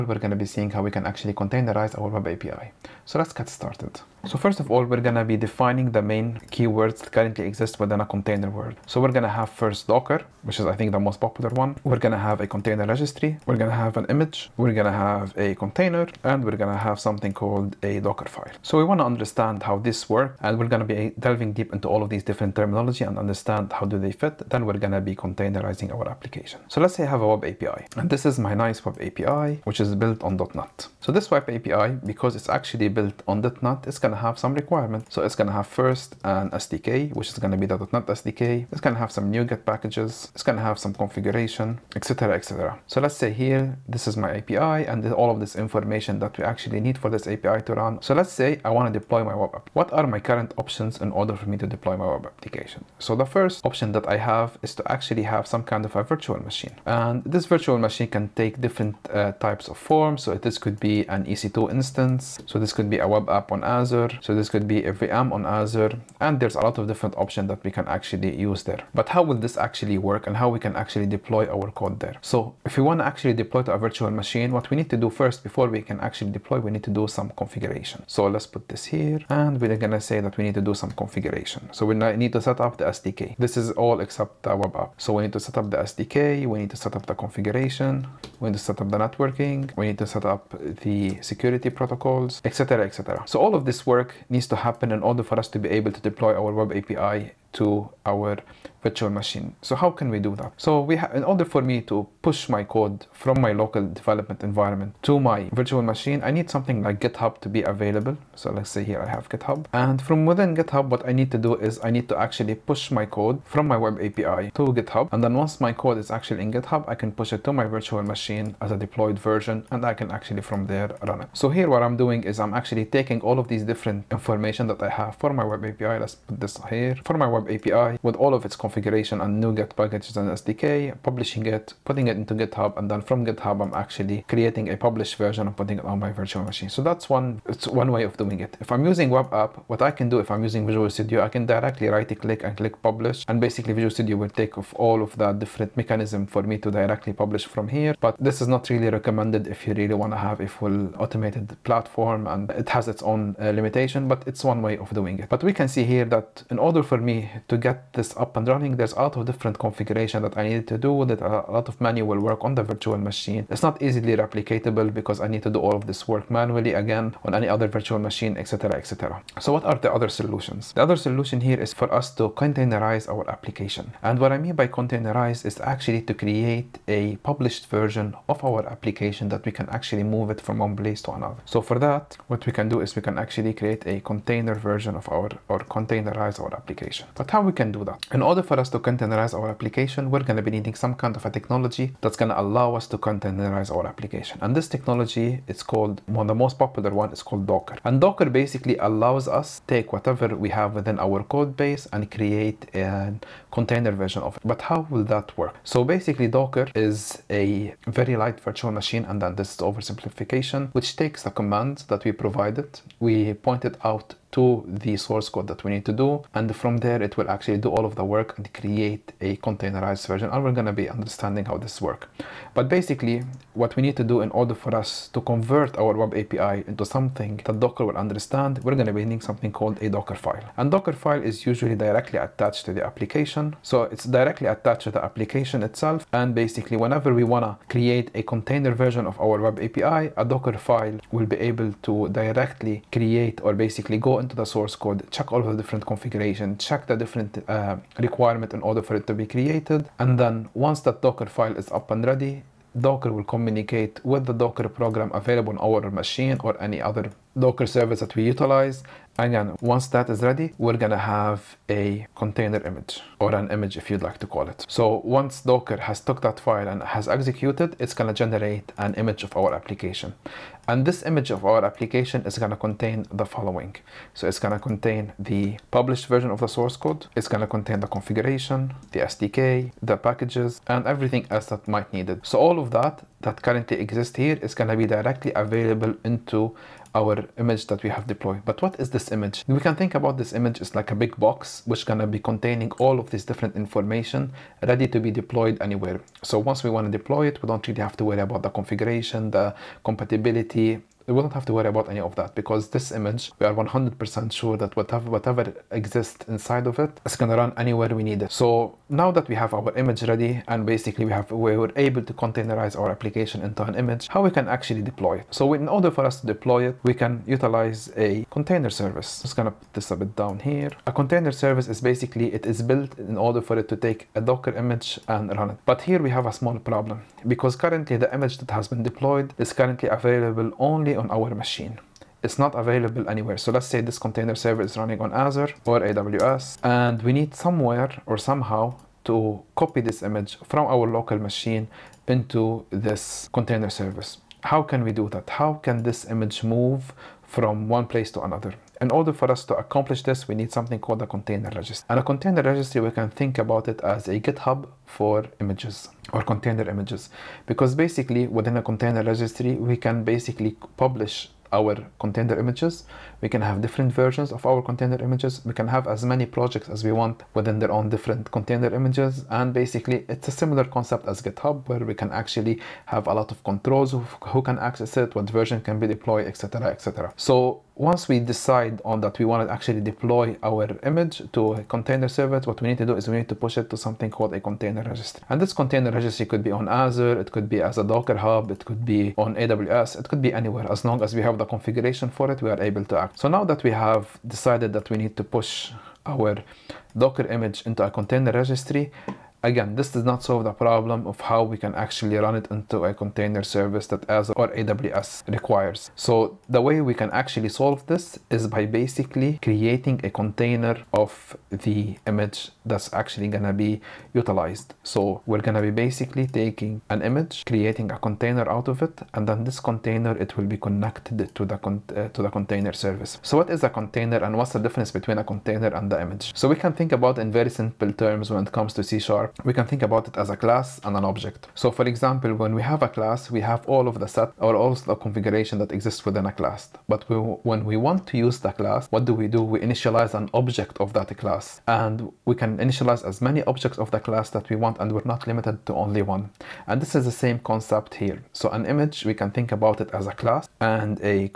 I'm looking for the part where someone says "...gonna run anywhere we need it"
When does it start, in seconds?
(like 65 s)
307 s.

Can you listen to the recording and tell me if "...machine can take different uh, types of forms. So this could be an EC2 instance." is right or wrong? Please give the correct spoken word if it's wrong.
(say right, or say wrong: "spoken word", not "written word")
right.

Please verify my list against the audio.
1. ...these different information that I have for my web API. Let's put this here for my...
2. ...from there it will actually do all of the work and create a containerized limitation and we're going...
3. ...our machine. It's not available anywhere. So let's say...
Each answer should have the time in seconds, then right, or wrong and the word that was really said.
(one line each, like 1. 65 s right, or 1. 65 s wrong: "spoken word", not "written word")
1. 123 s right
2. 216 s wrong: "version", not "limitation"
3. 331 s right.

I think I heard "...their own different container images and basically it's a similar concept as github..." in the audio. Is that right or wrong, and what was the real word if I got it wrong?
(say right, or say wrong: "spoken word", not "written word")
right.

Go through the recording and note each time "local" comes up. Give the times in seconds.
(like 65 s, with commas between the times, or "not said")
103 s, 340 s.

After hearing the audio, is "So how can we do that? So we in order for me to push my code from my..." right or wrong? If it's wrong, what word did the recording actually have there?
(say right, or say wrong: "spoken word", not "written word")
right.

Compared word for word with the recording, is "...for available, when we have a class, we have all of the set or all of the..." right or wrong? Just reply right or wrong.
wrong.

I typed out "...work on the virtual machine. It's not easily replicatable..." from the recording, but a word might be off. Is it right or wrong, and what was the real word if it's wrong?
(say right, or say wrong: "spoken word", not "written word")
right.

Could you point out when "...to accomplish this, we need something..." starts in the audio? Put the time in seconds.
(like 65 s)
349 s.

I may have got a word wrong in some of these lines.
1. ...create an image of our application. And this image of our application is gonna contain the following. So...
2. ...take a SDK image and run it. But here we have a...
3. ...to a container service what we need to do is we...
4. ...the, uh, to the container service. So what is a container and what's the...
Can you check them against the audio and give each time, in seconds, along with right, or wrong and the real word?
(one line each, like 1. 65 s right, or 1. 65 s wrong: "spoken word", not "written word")
1. 268 s wrong: "generate", not "create"
2. 323 s wrong: "Docker", not "SDK"
3. 381 s right
4. 421 s right.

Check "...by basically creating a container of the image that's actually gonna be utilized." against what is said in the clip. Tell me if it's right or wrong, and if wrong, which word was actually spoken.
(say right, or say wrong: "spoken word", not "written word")
right.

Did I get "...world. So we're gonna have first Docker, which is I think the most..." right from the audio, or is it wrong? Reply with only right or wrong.
right.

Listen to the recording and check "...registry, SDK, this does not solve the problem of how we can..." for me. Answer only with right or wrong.
wrong.